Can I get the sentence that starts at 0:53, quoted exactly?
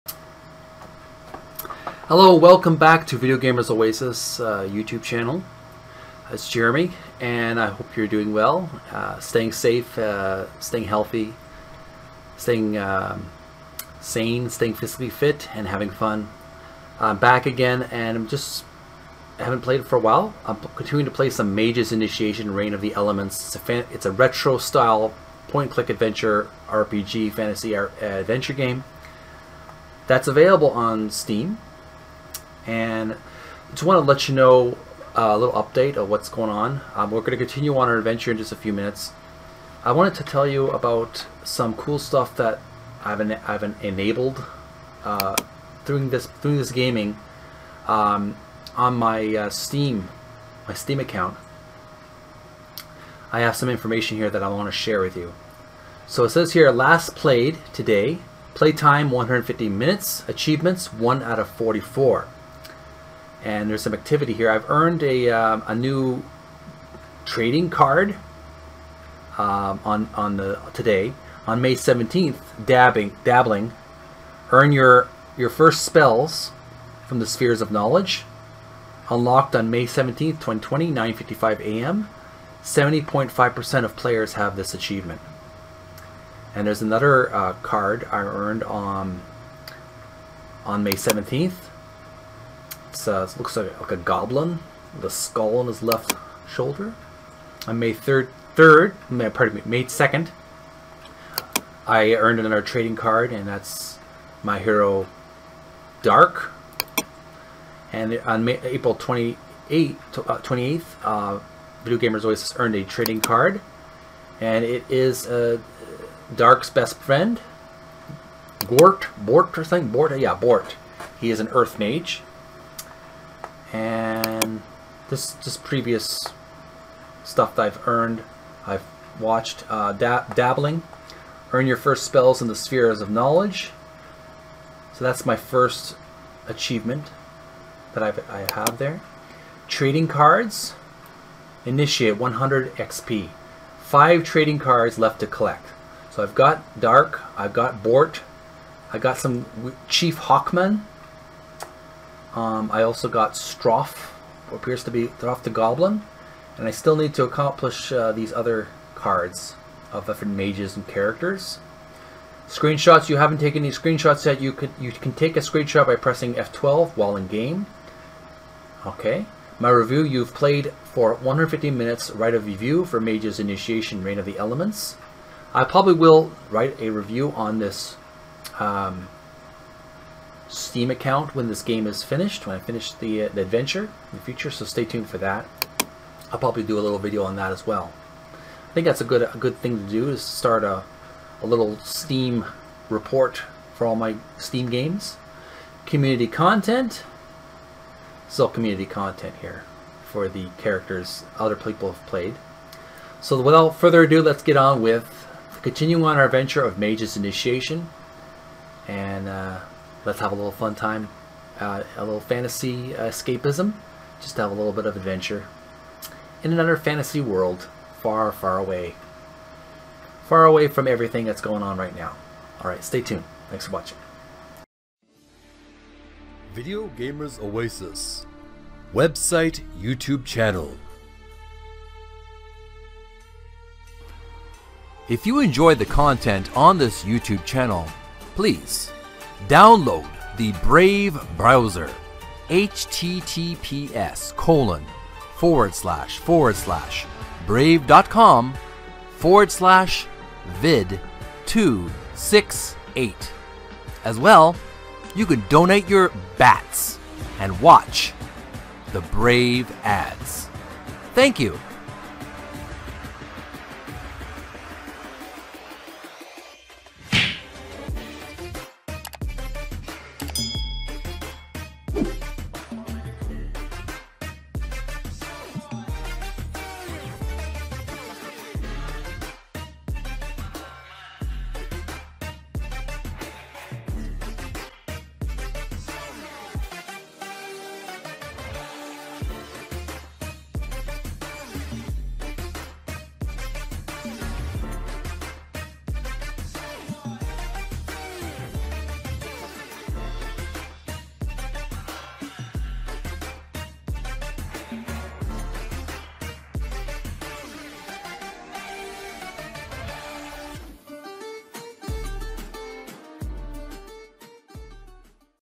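I have some information here that I want to share with you.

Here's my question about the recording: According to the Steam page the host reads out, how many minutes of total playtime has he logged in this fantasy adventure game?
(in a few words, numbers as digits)
150.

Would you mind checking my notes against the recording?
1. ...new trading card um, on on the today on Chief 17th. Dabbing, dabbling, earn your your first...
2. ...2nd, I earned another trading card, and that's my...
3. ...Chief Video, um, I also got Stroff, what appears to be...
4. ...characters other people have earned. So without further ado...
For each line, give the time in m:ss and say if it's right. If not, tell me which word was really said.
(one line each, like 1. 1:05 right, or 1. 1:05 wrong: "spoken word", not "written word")
1. 1:05 wrong: "May", not "Chief"
2. 1:39 right
3. 2:29 wrong: "Hawkman", not "Video"
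4. 3:20 wrong: "played", not "earned".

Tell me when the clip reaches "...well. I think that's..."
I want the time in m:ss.
3:07.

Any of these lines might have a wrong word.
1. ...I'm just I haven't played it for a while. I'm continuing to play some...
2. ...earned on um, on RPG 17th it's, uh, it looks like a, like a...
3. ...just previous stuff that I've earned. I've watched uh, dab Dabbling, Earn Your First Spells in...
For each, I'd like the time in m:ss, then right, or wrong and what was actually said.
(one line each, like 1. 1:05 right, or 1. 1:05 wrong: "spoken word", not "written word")
1. 0:18 right
2. 1:28 wrong: "May", not "RPG"
3. 2:05 right.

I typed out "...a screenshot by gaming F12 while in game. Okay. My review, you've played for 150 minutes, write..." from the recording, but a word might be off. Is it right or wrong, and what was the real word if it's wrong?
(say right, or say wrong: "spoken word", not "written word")
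wrong: "pressing", not "gaming".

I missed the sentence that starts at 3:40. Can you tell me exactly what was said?
Far away from everything that's going on right now.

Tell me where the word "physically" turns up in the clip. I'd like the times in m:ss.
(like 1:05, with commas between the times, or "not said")
0:14.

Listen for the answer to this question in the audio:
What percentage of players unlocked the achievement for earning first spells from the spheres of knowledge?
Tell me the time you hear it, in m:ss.
1:22.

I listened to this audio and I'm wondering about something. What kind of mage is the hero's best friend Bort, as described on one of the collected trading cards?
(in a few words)
Earth Mage.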